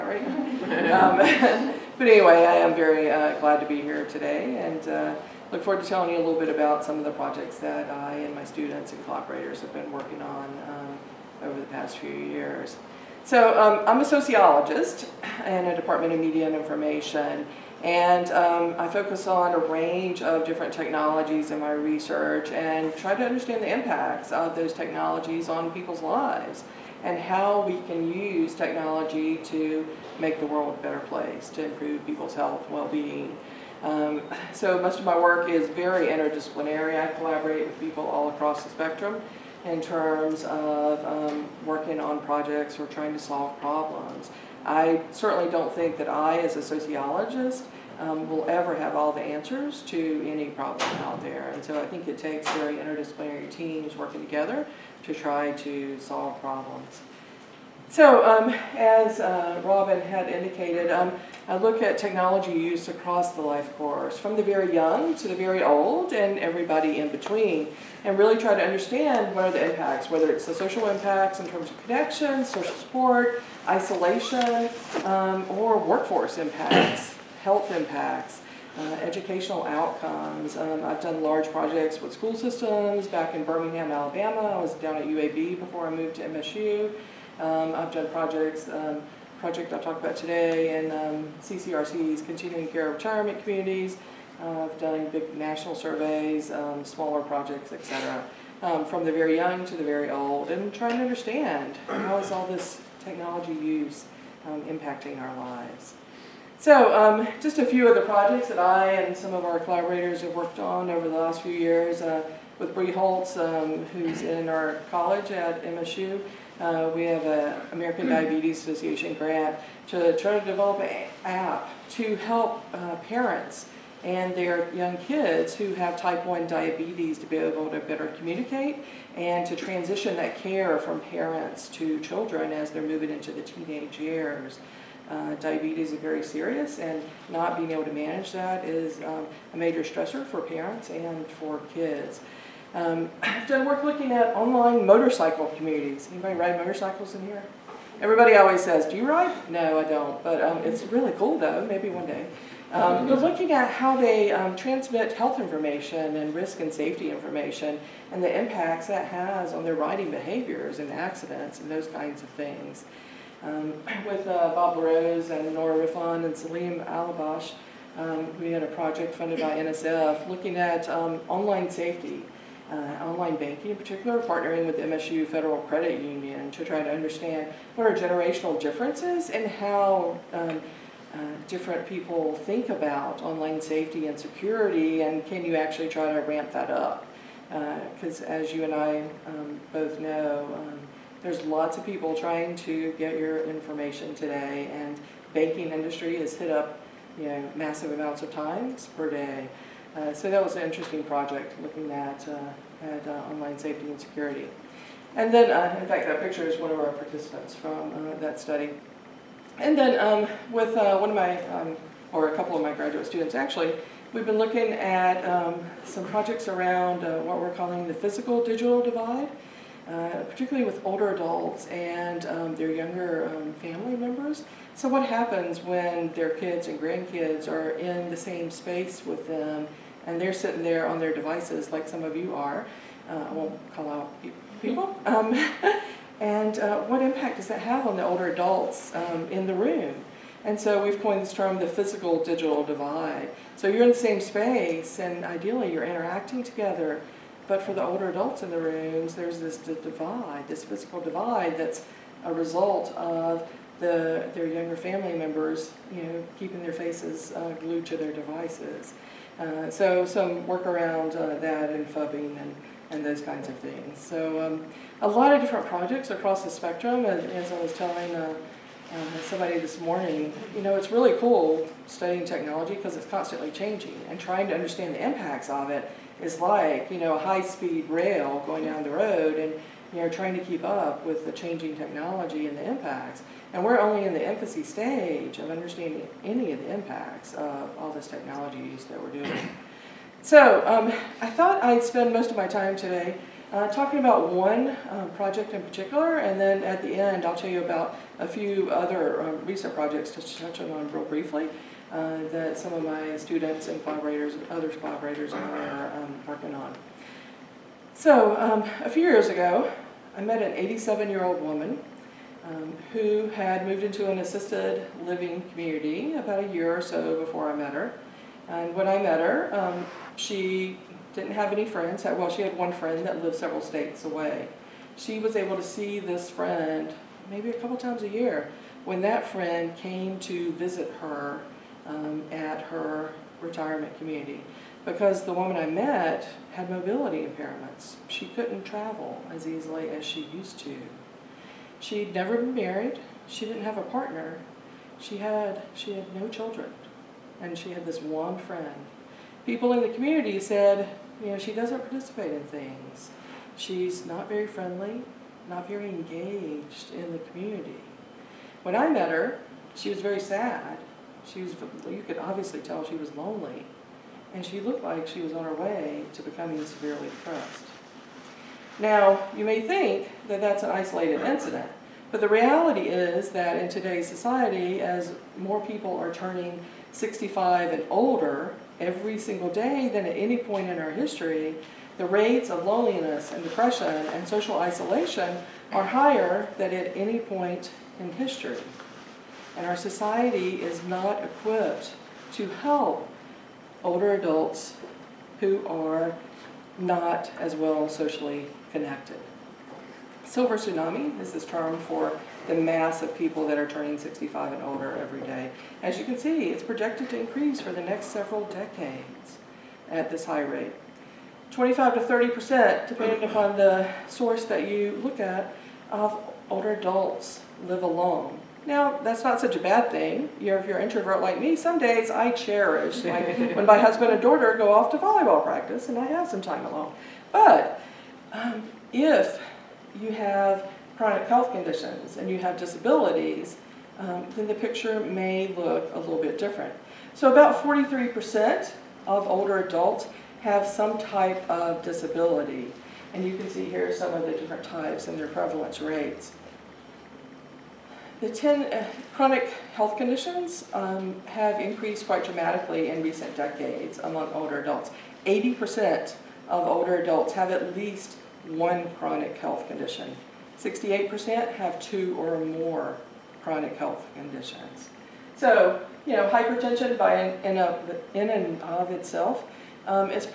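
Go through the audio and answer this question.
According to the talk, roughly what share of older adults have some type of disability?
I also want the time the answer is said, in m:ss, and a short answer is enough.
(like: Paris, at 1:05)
43%, at 7:17.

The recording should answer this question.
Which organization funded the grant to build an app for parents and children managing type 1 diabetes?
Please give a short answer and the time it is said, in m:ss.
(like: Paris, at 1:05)
American Diabetes Association, at 1:57.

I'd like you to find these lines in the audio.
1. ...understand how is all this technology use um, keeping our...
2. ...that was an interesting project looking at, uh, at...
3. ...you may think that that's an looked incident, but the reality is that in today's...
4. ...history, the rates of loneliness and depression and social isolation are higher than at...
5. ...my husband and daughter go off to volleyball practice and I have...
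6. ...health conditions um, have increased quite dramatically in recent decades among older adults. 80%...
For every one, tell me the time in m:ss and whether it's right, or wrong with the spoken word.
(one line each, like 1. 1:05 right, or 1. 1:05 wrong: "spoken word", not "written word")
1. 1:41 wrong: "impacting", not "keeping"
2. 3:20 right
3. 6:09 wrong: "isolated", not "looked"
4. 6:20 right
5. 7:03 right
6. 7:29 right.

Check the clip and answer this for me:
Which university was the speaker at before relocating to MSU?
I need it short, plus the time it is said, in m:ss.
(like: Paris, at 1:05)
UAB, at 1:25.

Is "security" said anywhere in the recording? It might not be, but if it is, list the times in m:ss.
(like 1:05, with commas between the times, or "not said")
3:04, 3:23.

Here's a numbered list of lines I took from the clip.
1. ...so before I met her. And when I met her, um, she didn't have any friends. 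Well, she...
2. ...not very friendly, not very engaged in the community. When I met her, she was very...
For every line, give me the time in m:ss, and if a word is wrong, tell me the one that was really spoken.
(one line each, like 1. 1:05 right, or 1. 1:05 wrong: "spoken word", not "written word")
1. 5:16 right
2. 5:54 right.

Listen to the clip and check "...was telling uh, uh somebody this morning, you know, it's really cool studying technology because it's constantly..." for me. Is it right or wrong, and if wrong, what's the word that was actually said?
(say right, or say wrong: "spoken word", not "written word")
right.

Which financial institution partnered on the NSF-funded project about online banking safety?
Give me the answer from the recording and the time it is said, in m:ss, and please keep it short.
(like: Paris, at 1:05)
MSU Federal Credit Union, at 2:54.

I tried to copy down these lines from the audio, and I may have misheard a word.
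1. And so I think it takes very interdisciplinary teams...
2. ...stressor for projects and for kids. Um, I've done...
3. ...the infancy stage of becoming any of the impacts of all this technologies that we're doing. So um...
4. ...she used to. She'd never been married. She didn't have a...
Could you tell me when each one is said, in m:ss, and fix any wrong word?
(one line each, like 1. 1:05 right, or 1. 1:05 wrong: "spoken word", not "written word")
1. 0:51 right
2. 2:19 wrong: "parents", not "projects"
3. 4:44 wrong: "understanding", not "becoming"
4. 5:40 right.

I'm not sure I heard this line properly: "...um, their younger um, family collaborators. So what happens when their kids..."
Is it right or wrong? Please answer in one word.
wrong.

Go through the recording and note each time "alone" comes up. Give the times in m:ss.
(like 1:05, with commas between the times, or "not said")
6:57, 7:06.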